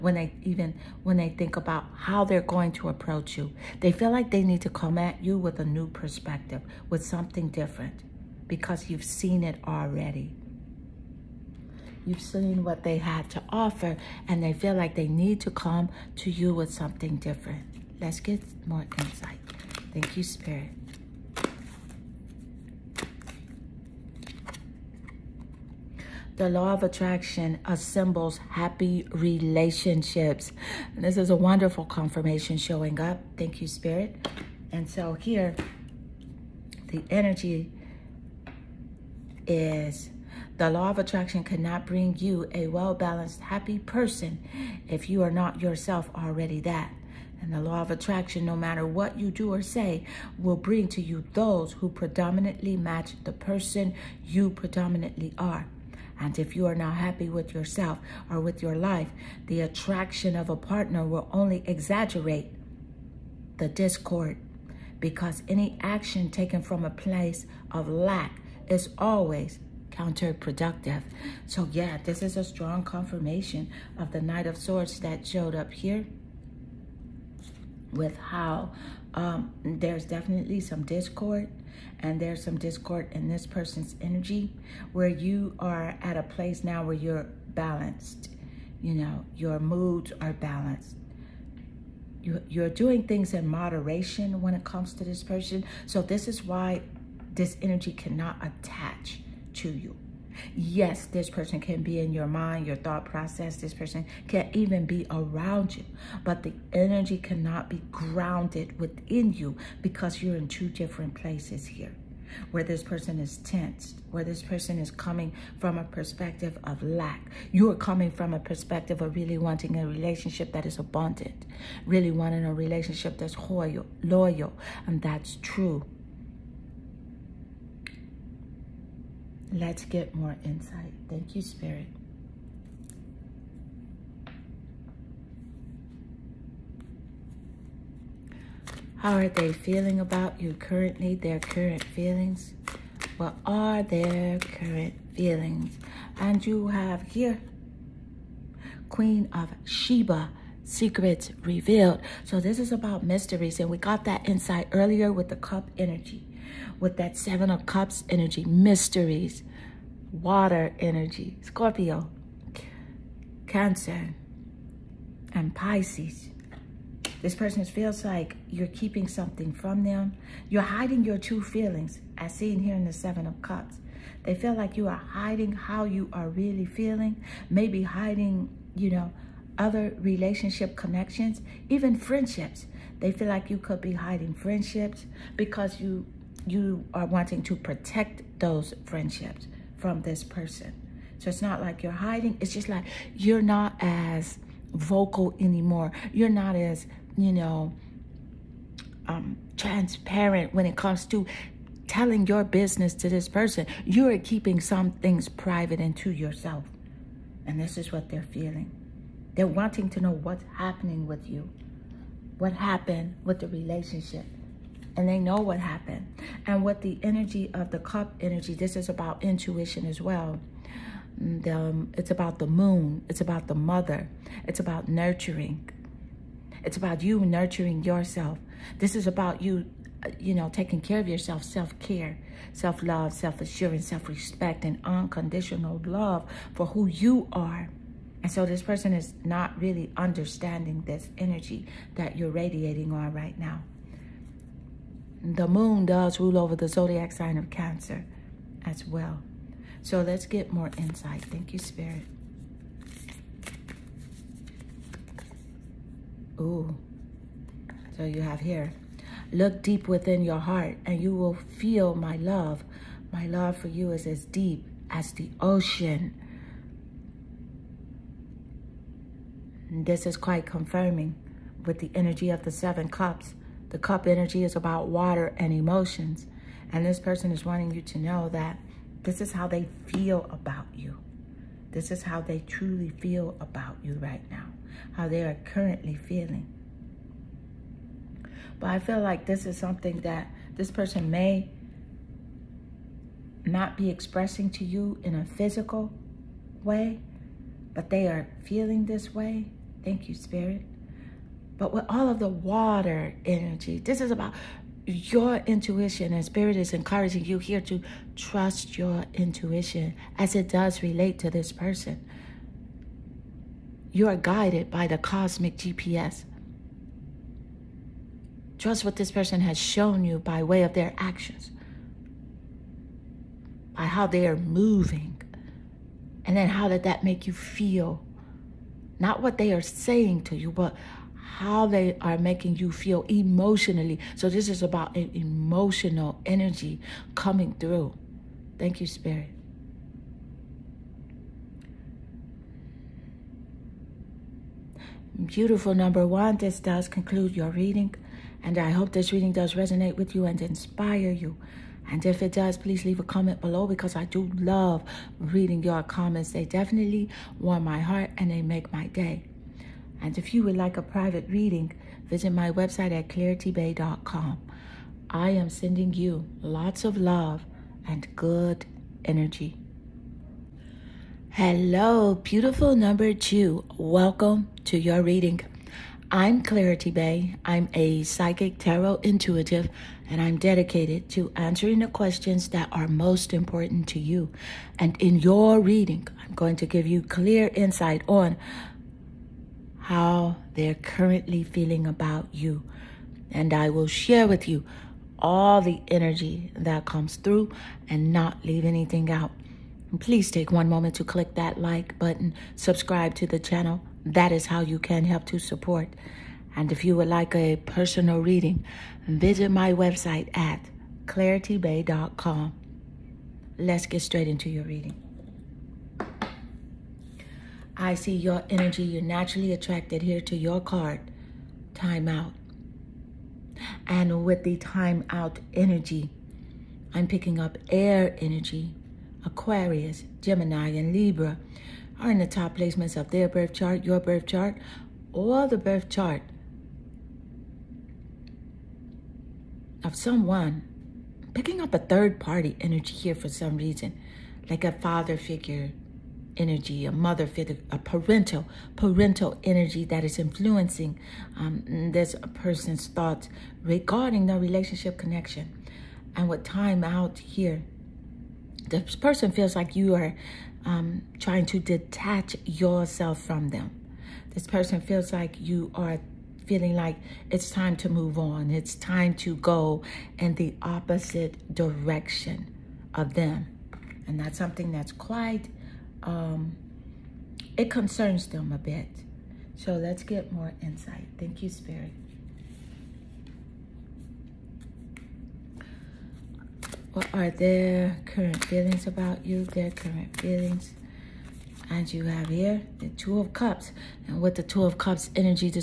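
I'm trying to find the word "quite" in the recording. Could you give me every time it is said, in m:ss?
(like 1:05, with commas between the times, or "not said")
4:30, 7:54.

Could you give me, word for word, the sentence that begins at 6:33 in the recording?
And I will share with you all the energy that comes through and not leave anything out.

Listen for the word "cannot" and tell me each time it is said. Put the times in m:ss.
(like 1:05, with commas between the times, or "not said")
0:41, 1:37, 1:47.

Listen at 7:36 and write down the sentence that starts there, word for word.
And with time out here, this person feels like you are um, trying to detach yourself from them.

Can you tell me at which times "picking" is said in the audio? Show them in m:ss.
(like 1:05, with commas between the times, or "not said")
7:07, 7:21.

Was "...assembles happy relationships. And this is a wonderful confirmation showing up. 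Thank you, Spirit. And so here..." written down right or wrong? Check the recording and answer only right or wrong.
right.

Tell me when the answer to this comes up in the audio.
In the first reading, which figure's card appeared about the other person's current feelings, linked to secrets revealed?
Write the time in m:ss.
2:28.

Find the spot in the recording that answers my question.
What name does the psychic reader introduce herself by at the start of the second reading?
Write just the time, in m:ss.
6:16.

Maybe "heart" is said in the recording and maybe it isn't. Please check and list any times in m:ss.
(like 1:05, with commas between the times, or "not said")
4:20, 5:57.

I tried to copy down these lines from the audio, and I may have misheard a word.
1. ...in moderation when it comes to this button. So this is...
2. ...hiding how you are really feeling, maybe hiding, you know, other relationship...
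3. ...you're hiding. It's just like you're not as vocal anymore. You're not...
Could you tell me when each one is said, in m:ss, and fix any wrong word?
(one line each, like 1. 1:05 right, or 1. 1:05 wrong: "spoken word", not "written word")
1. 1:33 wrong: "person", not "button"
2. 2:55 right
3. 3:11 right.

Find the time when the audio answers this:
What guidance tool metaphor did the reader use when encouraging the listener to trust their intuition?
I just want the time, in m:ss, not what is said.
5:14.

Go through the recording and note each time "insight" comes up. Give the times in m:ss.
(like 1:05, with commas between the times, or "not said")
0:18, 2:10, 2:34, 4:10, 6:27, 8:00.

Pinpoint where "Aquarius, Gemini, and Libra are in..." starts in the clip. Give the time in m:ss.
7:09.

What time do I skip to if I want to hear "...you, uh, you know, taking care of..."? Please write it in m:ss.
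3:49.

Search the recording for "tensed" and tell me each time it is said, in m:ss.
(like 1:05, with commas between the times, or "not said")
1:53.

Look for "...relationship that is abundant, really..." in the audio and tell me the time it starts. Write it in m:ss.
1:59.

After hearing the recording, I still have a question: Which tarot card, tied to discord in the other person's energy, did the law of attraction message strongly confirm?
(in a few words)
Knight of Swords.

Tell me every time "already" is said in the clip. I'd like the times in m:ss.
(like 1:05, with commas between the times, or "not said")
0:09, 0:46.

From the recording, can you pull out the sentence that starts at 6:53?
Let's get straight into your reading.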